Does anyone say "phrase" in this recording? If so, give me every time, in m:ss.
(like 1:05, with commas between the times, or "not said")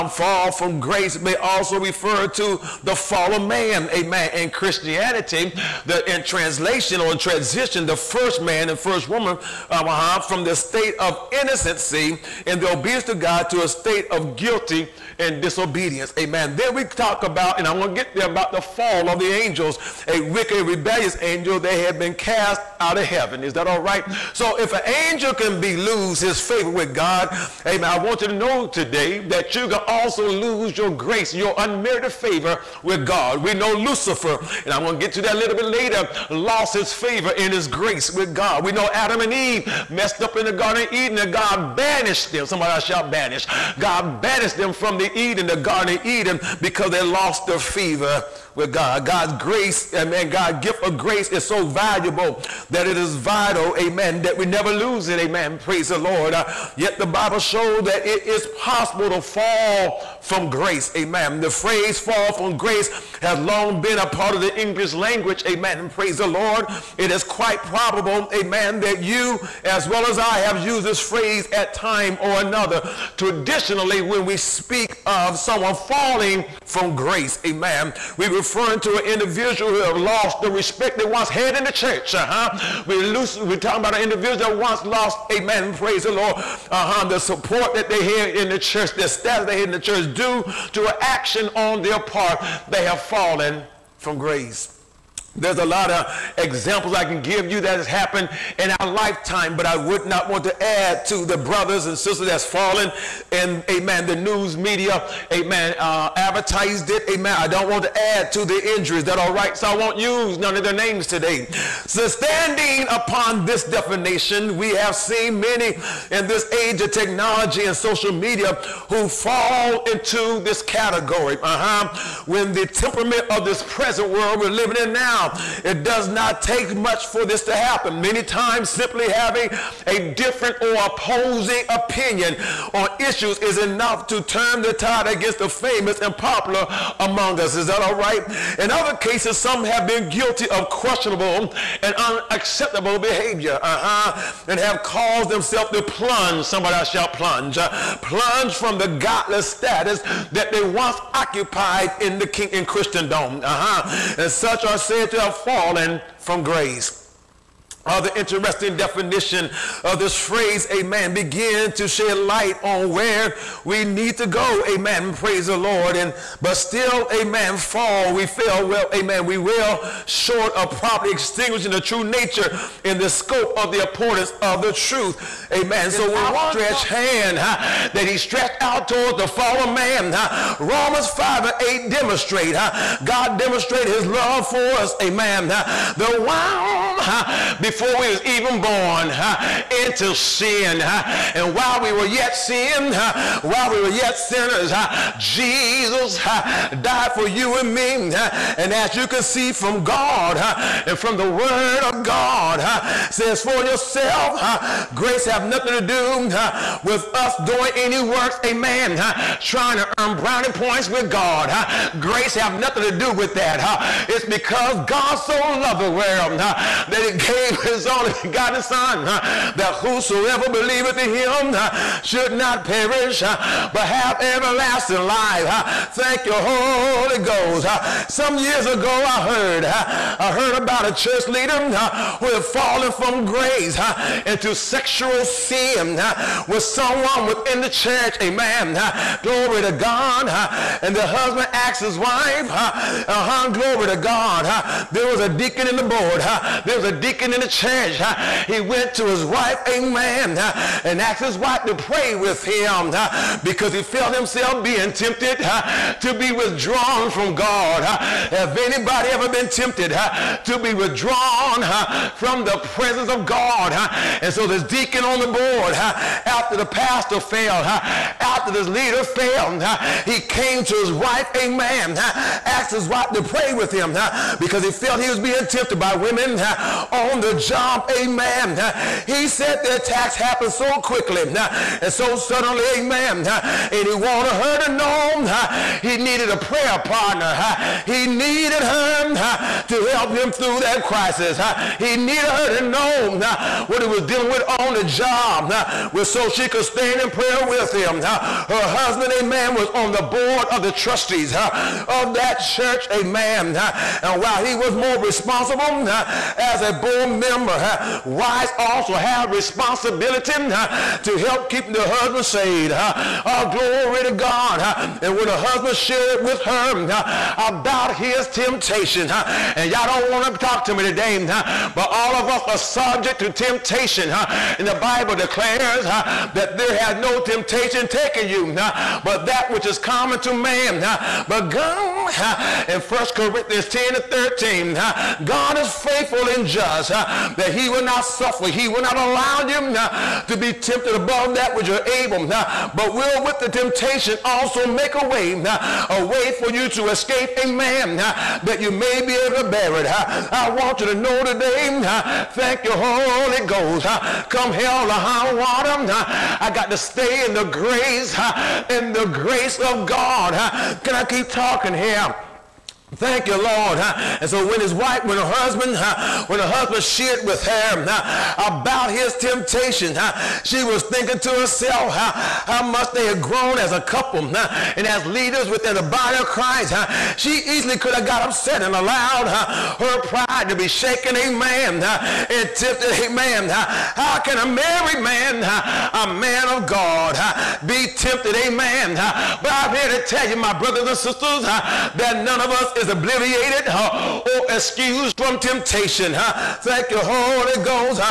1:01, 1:10, 2:40.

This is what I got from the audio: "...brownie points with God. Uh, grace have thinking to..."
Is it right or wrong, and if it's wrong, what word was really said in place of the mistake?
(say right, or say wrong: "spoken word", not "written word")
wrong: "nothing", not "thinking".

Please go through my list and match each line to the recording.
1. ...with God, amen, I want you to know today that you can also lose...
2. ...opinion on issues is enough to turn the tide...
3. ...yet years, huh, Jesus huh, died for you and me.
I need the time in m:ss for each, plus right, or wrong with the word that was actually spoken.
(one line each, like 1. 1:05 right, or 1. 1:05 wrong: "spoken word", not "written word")
1. 0:26 right
2. 2:11 right
3. 3:13 wrong: "sinners", not "years".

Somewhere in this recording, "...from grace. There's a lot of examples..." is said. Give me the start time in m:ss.
1:33.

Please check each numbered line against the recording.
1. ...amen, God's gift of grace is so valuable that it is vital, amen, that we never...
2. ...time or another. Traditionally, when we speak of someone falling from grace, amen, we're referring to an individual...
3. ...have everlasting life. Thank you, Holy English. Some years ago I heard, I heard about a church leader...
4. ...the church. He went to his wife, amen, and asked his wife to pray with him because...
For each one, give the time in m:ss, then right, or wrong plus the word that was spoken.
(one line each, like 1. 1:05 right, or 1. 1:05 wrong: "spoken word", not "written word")
1. 0:49 right
2. 1:11 right
3. 3:43 wrong: "Ghost", not "English"
4. 4:07 right.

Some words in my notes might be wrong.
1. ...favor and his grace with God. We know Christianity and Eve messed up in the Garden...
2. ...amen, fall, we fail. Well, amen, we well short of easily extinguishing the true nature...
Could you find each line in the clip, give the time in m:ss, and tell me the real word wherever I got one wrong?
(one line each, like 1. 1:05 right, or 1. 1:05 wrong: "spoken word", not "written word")
1. 0:36 wrong: "Adam", not "Christianity"
2. 2:47 wrong: "properly", not "easily".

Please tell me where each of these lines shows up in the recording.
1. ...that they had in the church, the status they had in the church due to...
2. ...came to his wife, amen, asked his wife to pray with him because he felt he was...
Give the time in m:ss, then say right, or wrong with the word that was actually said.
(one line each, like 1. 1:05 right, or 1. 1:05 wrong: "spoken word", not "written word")
1. 1:27 right
2. 4:30 right.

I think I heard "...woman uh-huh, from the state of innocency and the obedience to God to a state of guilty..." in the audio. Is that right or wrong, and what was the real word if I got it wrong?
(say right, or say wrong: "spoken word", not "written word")
right.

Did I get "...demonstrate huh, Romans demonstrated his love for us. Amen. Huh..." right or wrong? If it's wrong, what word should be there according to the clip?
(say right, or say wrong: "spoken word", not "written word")
wrong: "God", not "Romans".